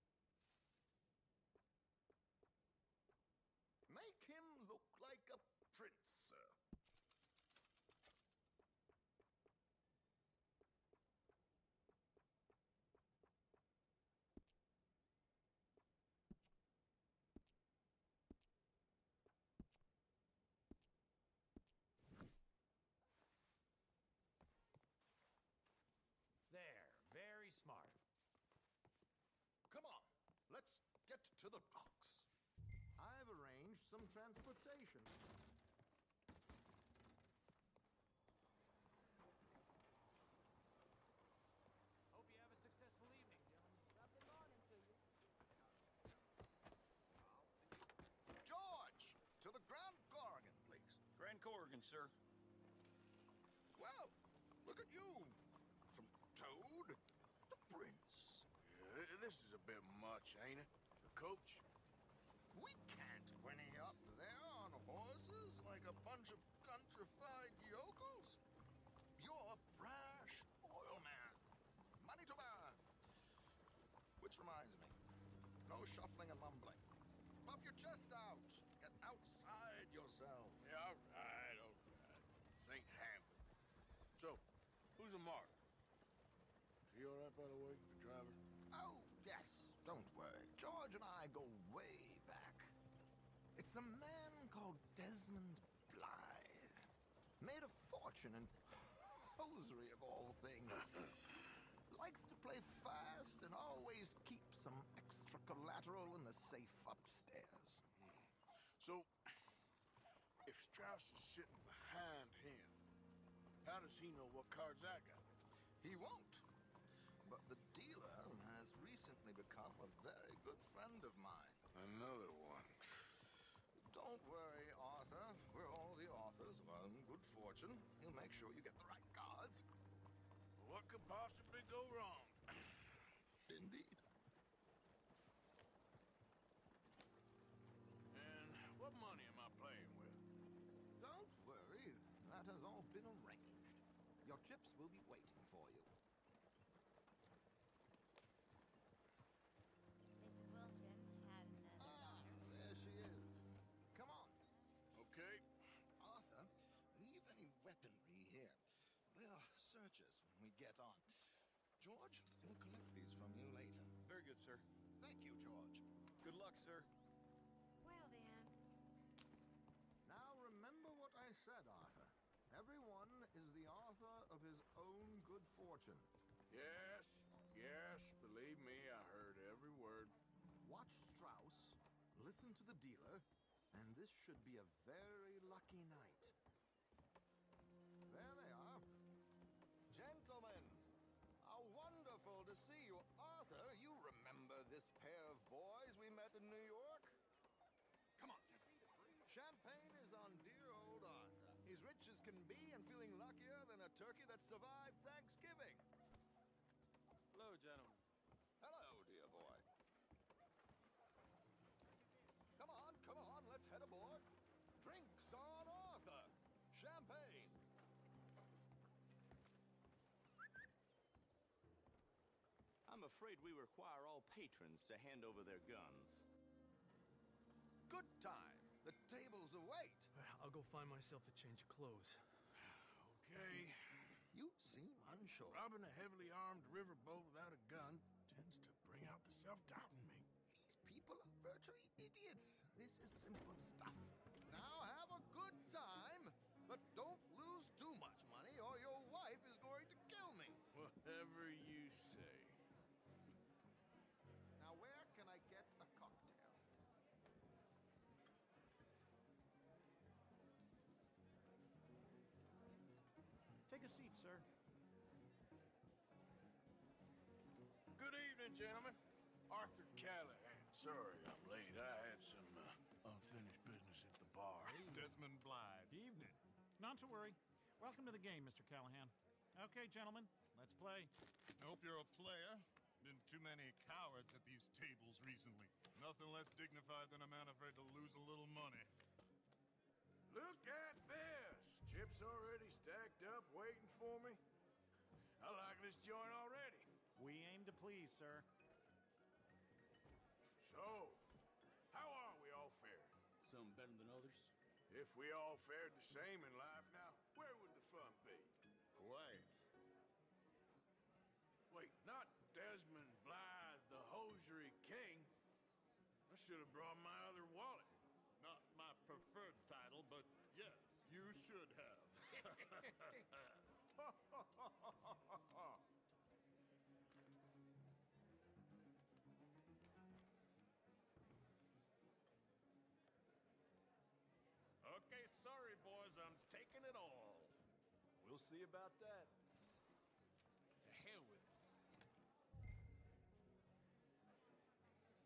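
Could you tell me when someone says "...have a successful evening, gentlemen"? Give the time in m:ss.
0:42.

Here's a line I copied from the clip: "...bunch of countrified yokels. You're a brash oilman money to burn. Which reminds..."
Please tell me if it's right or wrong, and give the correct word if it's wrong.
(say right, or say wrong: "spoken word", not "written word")
right.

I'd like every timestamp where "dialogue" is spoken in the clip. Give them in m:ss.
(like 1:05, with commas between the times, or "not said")
not said.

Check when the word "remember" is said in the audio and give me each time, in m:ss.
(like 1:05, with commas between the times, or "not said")
2:50, 3:13.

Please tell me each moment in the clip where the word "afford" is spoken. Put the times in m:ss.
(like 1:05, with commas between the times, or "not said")
not said.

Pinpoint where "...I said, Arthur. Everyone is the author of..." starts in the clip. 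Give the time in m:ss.
2:51.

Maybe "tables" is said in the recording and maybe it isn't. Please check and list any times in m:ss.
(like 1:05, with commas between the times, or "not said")
3:49, 4:44.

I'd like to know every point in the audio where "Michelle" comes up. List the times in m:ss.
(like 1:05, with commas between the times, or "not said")
not said.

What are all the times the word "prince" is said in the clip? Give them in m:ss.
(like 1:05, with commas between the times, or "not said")
0:05, 0:57.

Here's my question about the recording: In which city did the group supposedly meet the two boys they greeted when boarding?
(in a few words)
New York.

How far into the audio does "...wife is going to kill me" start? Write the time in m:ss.
4:09.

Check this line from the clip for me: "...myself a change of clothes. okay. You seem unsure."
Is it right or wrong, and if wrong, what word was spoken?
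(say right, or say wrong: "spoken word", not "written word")
right.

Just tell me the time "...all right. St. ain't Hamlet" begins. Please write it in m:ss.
1:21.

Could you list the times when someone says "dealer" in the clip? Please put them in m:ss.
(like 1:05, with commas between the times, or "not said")
1:57, 3:02.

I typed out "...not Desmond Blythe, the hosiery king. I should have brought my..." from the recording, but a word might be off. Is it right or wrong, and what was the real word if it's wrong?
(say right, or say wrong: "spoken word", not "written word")
right.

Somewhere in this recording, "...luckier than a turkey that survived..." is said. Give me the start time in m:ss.
3:23.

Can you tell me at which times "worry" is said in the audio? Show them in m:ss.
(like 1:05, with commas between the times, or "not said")
1:30, 2:04, 2:21, 4:37.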